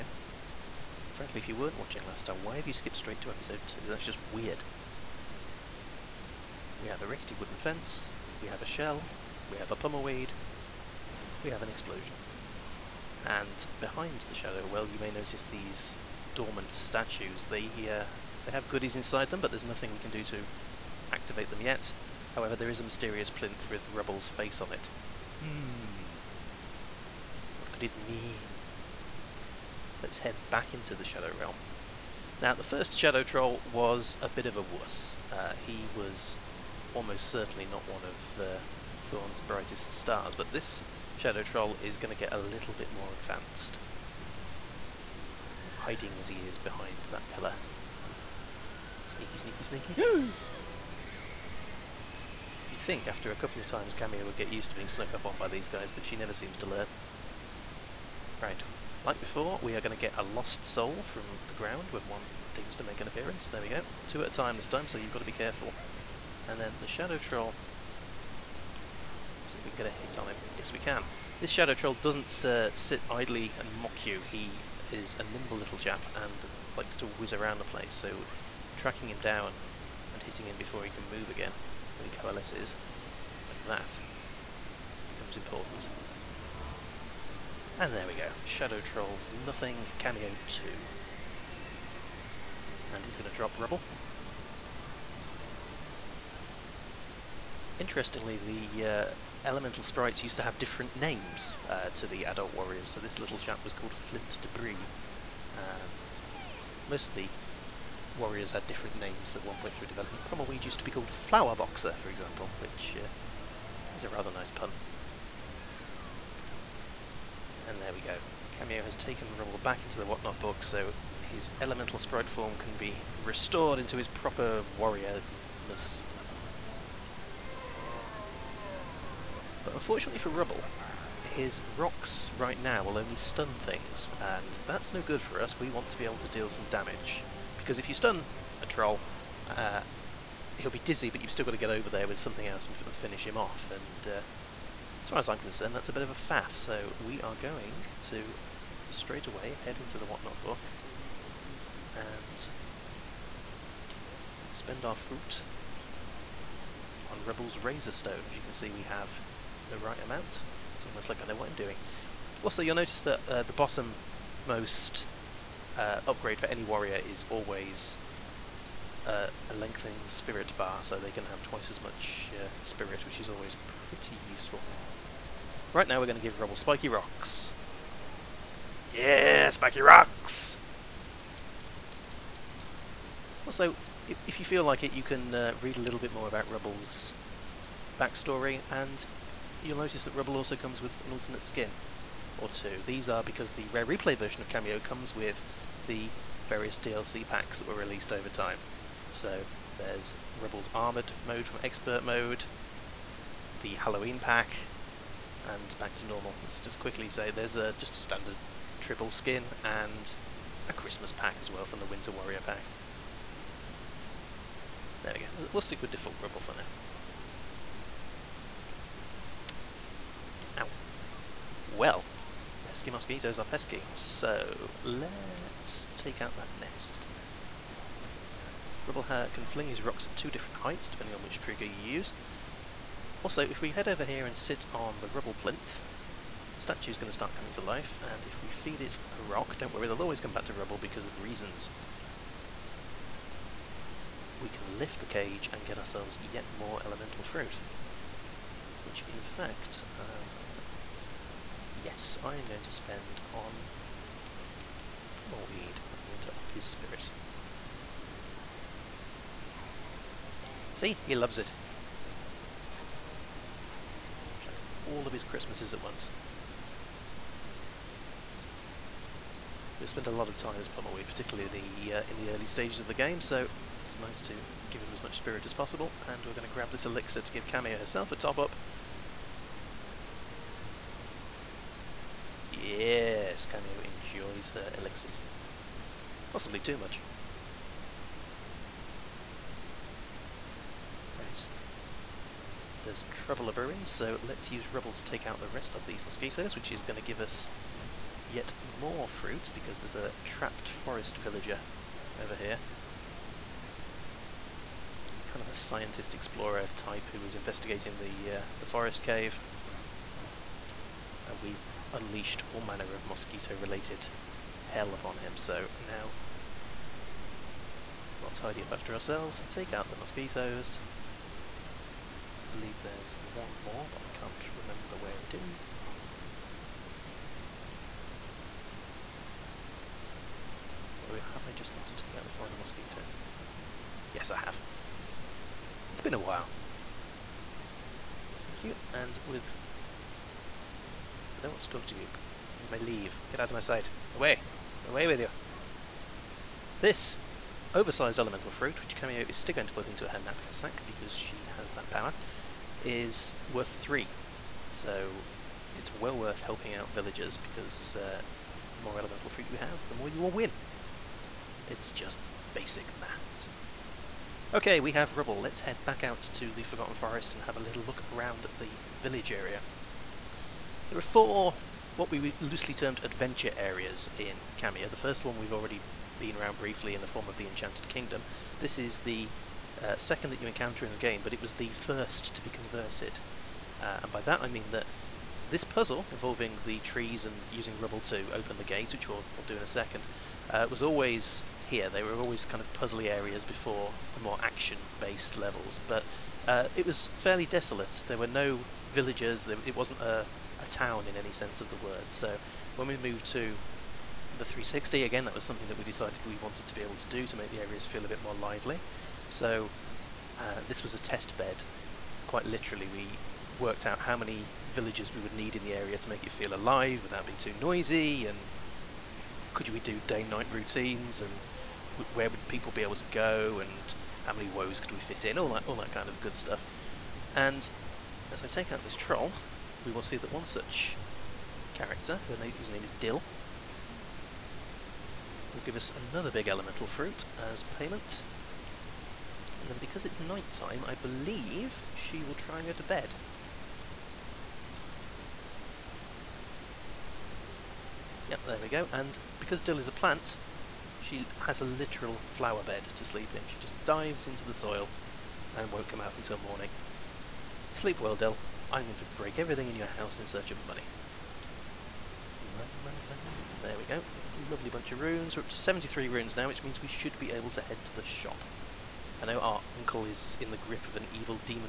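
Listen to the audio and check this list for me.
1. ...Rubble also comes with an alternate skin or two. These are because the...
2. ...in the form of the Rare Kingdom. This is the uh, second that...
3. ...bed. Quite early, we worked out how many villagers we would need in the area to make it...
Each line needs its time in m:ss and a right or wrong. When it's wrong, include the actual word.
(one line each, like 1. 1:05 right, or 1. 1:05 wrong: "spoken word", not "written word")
1. 3:10 right
2. 6:16 wrong: "Enchanted", not "Rare"
3. 6:51 wrong: "literally", not "early".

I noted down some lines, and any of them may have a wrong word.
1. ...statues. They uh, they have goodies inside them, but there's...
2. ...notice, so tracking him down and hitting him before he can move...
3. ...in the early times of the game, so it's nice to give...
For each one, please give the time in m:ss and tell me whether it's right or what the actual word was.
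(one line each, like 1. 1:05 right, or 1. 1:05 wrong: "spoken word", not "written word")
1. 0:16 right
2. 1:17 wrong: "place", not "notice"
3. 4:32 wrong: "stages", not "times".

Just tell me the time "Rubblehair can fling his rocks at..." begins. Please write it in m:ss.
3:48.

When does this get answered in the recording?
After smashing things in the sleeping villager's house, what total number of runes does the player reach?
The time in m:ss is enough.
7:45.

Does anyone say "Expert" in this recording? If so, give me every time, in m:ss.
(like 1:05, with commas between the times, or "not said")
3:21.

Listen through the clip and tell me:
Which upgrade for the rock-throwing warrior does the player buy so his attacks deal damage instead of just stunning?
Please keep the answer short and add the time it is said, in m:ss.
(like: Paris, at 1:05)
Razor Stone, at 2:37.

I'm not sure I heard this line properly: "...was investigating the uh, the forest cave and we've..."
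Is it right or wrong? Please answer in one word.
right.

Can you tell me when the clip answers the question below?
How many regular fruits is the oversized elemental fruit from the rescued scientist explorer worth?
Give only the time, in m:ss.
5:53.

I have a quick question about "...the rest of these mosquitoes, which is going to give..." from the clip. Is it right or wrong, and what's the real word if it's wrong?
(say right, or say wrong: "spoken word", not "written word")
right.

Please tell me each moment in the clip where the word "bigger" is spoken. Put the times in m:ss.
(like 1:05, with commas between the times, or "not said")
not said.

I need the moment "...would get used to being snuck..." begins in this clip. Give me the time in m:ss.
0:54.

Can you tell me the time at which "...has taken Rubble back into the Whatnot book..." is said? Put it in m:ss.
1:58.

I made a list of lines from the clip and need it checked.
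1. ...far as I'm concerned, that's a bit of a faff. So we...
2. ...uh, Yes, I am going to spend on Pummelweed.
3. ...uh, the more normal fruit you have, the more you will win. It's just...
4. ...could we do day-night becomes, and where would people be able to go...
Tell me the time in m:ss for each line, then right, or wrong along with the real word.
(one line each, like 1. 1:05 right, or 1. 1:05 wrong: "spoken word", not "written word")
1. 2:25 right
2. 4:09 right
3. 5:57 wrong: "elemental", not "normal"
4. 6:59 wrong: "routines", not "becomes".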